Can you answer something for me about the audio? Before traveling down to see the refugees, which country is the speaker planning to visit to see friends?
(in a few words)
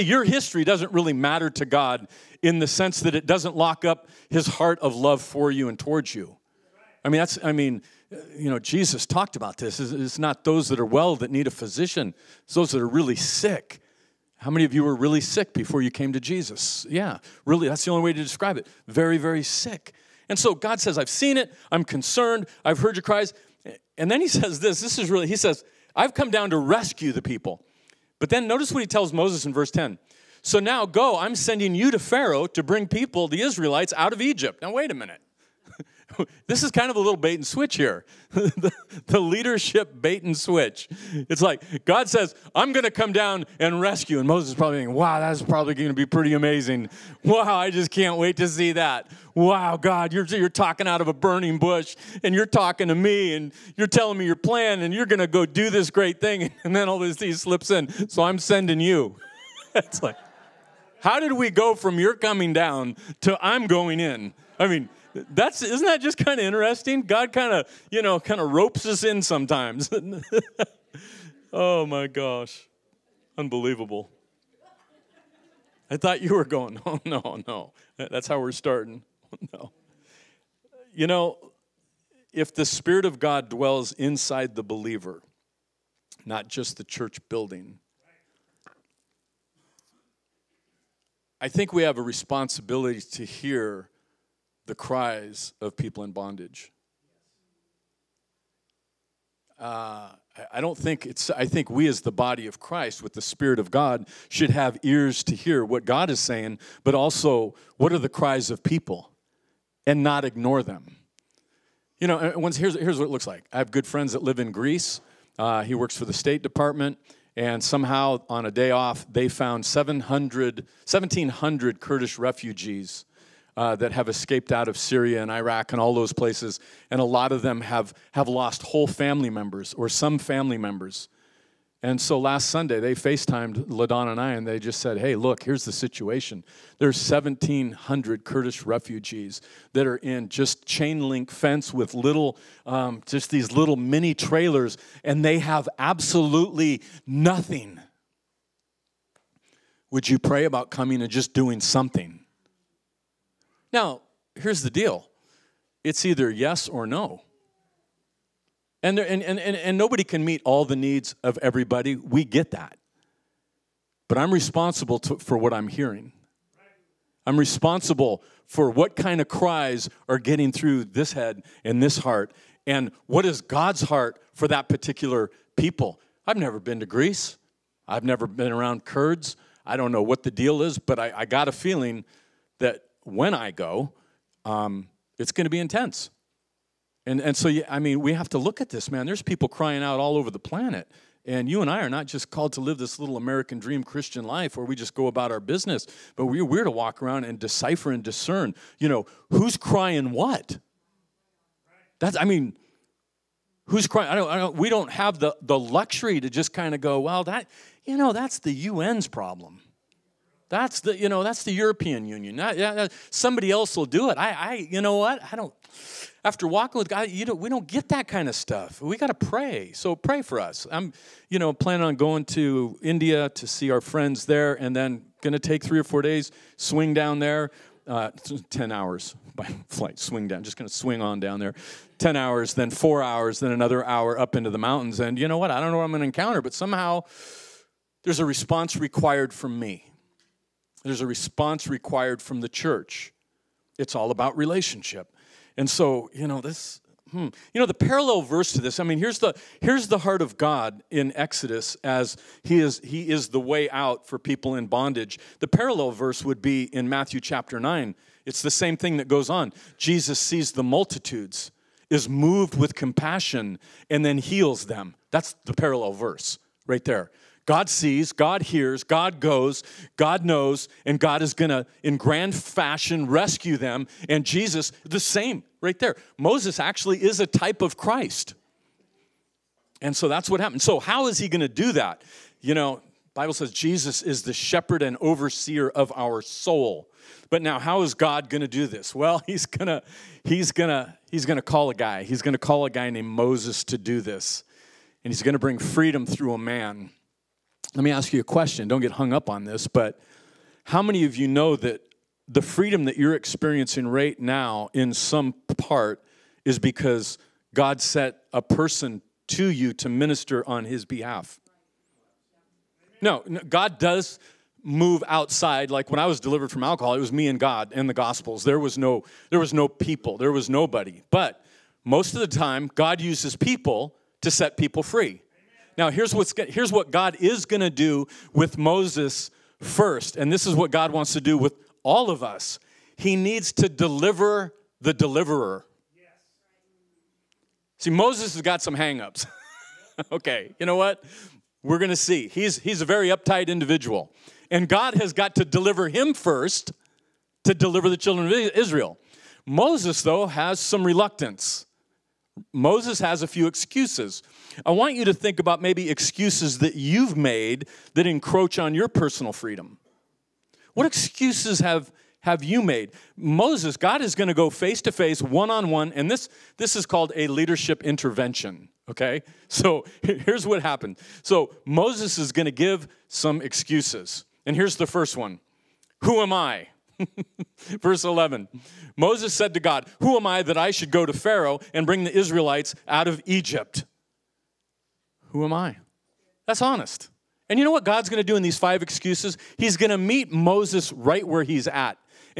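India.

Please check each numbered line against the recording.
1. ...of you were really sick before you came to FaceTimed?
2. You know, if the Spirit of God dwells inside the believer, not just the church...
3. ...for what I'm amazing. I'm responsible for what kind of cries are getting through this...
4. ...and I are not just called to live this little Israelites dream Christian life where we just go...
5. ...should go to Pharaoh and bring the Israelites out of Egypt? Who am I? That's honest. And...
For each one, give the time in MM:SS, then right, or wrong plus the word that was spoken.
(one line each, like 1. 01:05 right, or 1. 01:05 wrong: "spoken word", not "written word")
1. 00:14 wrong: "Jesus", not "FaceTimed"
2. 01:20 right
3. 02:45 wrong: "hearing", not "amazing"
4. 03:11 wrong: "American", not "Israelites"
5. 06:20 right.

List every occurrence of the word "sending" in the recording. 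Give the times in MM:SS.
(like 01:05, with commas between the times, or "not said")
00:31, 00:58.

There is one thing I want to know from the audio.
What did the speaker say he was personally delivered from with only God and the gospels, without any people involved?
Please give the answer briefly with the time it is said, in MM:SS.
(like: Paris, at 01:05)
Alcohol, at 05:16.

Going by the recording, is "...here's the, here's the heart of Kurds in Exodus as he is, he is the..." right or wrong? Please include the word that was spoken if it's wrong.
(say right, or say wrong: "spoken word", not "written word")
wrong: "God", not "Kurds".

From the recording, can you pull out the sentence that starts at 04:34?
And Jesus, the same right there.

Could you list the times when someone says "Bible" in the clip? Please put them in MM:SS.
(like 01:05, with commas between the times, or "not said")
04:43.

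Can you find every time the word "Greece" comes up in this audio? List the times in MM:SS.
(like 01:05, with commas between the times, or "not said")
01:54, 02:56.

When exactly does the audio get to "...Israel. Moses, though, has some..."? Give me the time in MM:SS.
05:48.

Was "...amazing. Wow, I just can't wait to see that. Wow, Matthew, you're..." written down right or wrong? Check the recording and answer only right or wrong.
wrong.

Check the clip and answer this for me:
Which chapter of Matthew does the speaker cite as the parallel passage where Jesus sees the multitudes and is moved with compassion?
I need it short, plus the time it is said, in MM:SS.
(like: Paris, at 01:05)
Chapter 9, at 04:17.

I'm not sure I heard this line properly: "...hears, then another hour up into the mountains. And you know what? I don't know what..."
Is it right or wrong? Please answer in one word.
wrong.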